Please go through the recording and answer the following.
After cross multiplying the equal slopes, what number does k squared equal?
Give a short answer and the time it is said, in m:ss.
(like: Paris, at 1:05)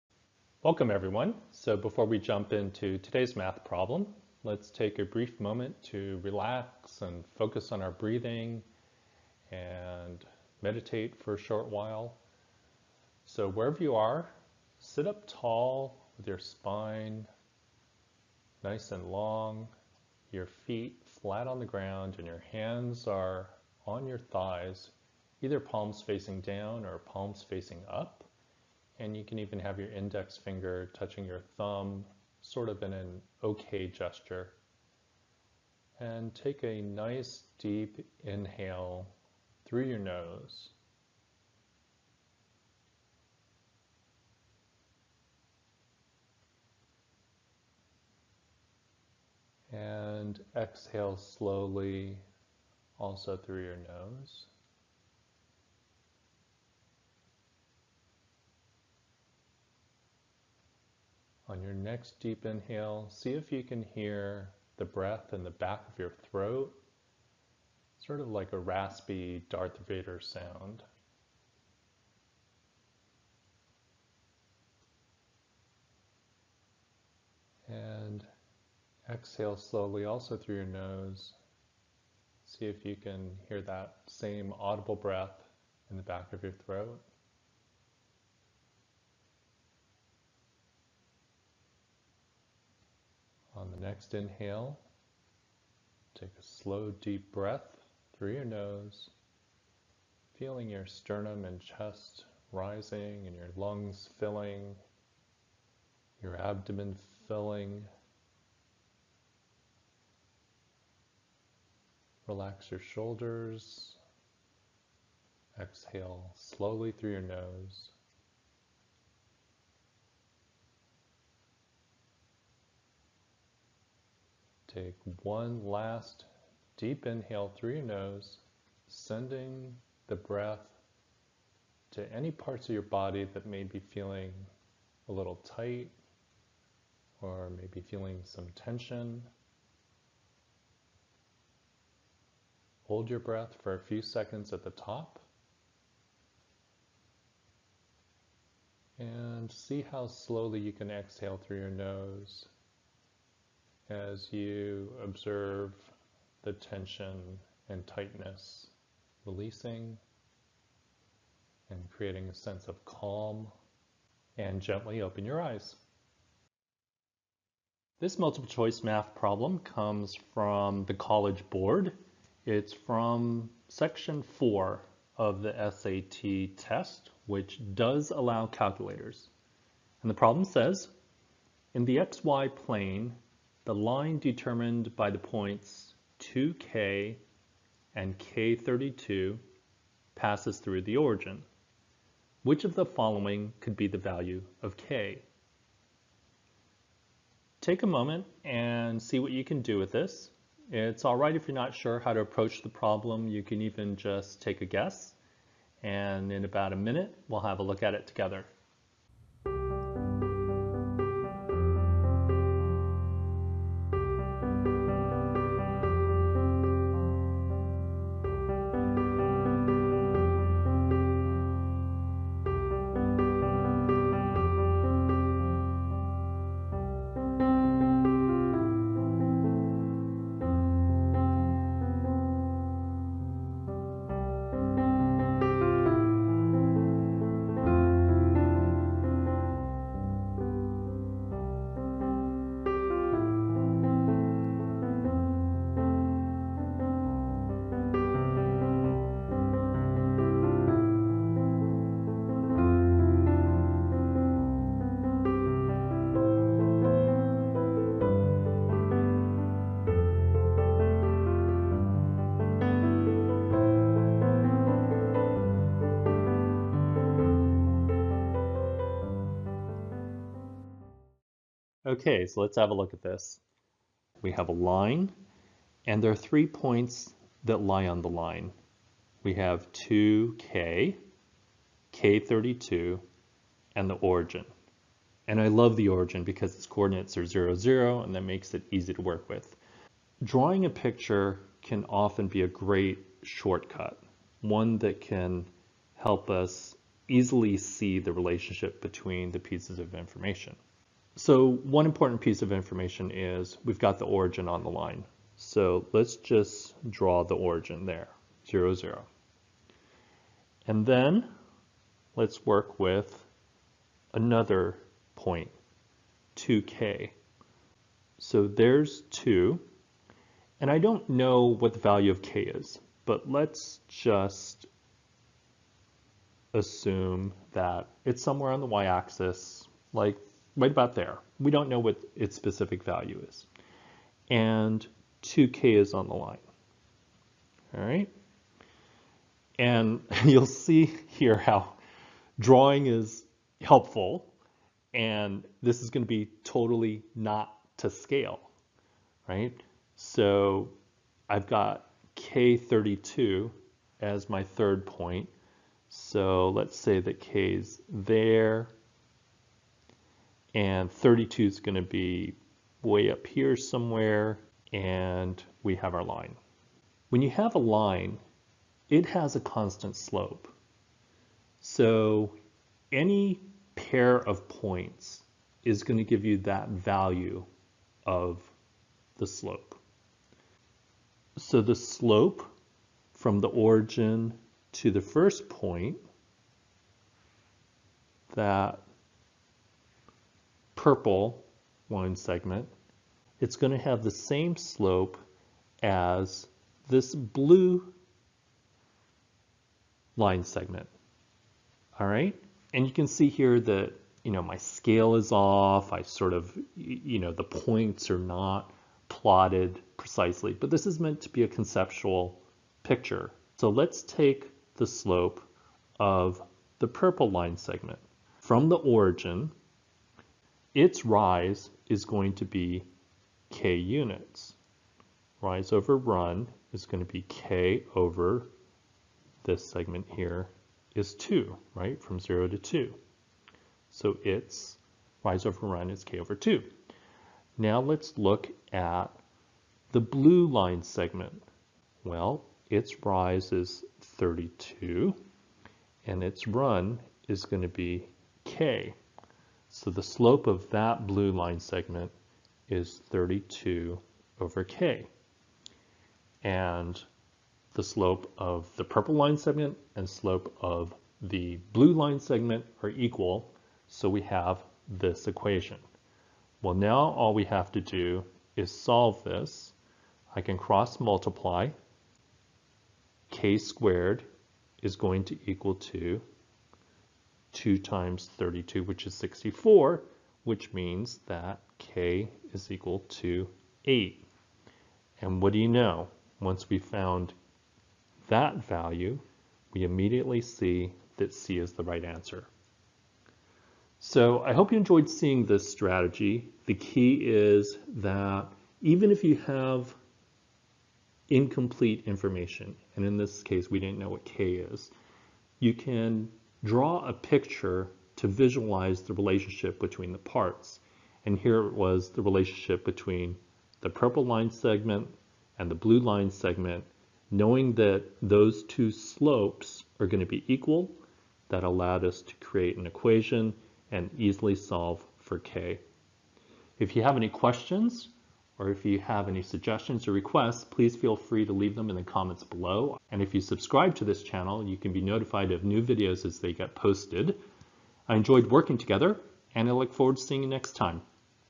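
64, at 7:59.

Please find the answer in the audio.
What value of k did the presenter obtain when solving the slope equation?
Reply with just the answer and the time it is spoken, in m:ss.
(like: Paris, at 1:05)
8, at 8:03.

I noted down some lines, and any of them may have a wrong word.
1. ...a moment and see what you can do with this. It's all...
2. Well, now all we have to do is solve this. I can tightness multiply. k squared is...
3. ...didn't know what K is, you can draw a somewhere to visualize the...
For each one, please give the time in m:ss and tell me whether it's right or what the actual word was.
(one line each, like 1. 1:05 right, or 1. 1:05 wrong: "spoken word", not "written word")
1. 3:17 right
2. 7:46 wrong: "cross", not "tightness"
3. 8:23 wrong: "picture", not "somewhere".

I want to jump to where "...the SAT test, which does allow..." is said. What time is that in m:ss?
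2:55.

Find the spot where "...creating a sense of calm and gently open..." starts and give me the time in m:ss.
2:41.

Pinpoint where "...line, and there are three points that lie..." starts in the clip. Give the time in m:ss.
4:34.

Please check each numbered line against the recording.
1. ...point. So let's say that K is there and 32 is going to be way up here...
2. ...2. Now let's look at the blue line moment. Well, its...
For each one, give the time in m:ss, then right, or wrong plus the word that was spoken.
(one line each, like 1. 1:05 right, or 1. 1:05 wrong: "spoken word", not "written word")
1. 5:54 right
2. 7:16 wrong: "segment", not "moment".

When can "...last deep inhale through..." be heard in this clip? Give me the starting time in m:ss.
2:05.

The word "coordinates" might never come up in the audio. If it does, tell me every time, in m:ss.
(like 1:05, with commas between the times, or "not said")
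4:46.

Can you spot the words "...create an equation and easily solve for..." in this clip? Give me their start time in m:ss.
8:42.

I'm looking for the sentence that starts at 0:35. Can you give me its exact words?
And take a nice deep inhale through your nose.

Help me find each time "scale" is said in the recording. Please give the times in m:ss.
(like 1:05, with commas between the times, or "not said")
5:47, 6:44.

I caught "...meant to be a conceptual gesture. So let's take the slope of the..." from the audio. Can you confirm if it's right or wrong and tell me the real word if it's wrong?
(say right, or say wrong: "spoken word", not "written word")
wrong: "picture", not "gesture".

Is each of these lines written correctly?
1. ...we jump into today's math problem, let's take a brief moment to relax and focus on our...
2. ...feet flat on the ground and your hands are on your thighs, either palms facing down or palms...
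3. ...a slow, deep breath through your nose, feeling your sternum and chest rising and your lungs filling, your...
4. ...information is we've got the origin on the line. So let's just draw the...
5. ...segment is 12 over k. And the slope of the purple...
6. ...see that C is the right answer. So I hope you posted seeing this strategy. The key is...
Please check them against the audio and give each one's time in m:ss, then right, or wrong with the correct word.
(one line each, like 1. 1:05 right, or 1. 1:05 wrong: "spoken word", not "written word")
1. 0:02 right
2. 0:20 right
3. 1:36 right
4. 5:02 right
5. 7:31 wrong: "32", not "12"
6. 8:10 wrong: "enjoyed", not "posted".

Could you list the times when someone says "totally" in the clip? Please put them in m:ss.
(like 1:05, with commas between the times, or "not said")
5:46.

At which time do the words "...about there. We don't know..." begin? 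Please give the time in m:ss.
5:30.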